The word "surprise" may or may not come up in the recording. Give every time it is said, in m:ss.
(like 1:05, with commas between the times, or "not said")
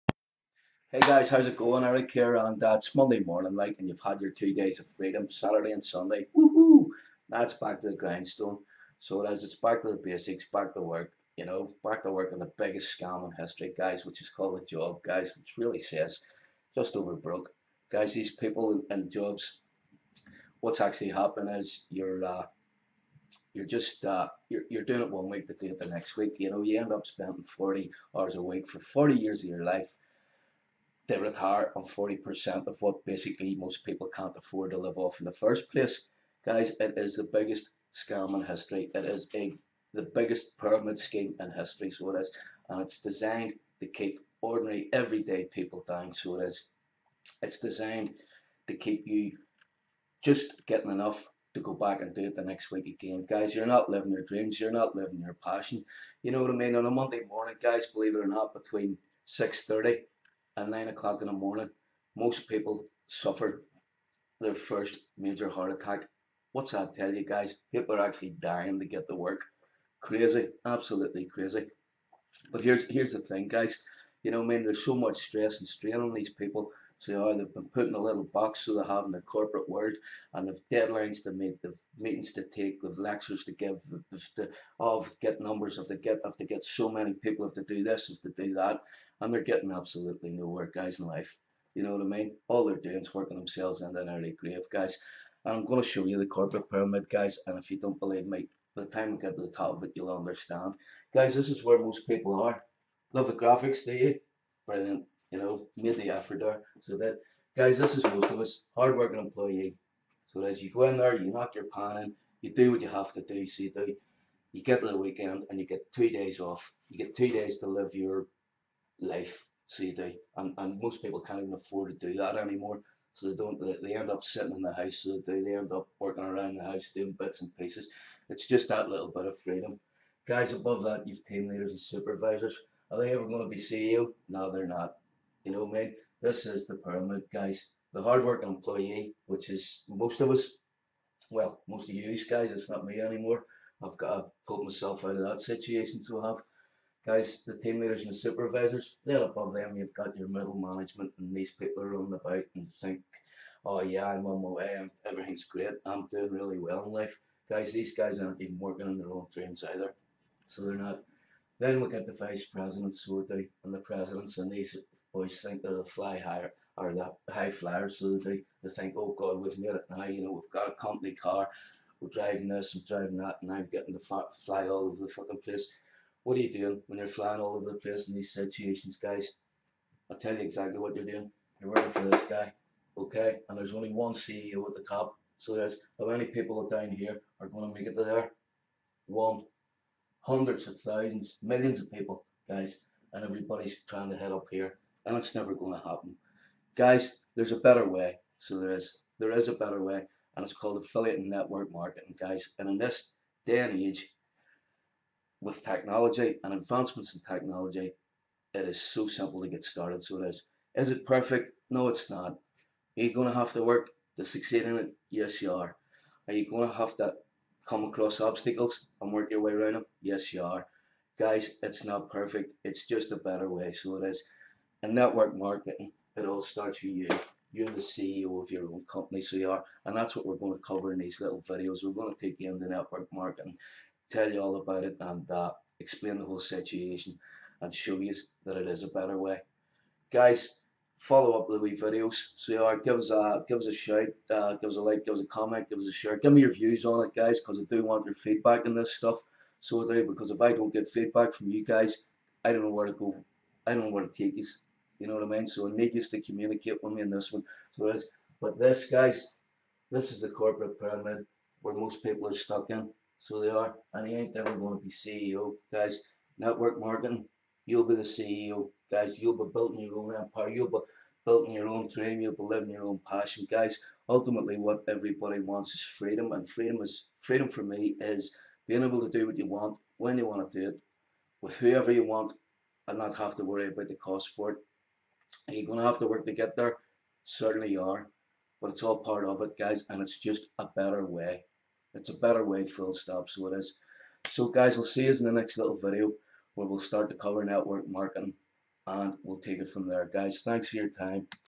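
not said.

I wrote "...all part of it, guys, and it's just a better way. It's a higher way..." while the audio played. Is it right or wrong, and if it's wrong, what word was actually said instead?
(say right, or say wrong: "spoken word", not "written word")
wrong: "better", not "higher".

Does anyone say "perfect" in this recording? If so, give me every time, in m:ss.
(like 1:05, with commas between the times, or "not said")
3:31, 3:42.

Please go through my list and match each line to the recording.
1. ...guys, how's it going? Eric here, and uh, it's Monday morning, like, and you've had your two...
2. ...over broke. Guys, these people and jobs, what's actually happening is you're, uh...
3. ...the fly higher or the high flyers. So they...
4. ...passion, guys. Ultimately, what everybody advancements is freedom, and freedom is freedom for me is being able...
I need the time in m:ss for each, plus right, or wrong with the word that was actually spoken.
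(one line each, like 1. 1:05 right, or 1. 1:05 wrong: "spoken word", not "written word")
1. 0:00 right
2. 0:16 right
3. 2:45 right
4. 4:33 wrong: "wants", not "advancements".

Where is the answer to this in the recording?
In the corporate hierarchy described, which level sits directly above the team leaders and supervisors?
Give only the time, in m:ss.
2:30.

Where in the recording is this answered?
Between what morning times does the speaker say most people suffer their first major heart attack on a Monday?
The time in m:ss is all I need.
0:59.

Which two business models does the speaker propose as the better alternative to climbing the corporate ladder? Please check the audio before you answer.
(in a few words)
Affiliate and network marketing.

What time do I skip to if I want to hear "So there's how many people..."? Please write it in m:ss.
3:05.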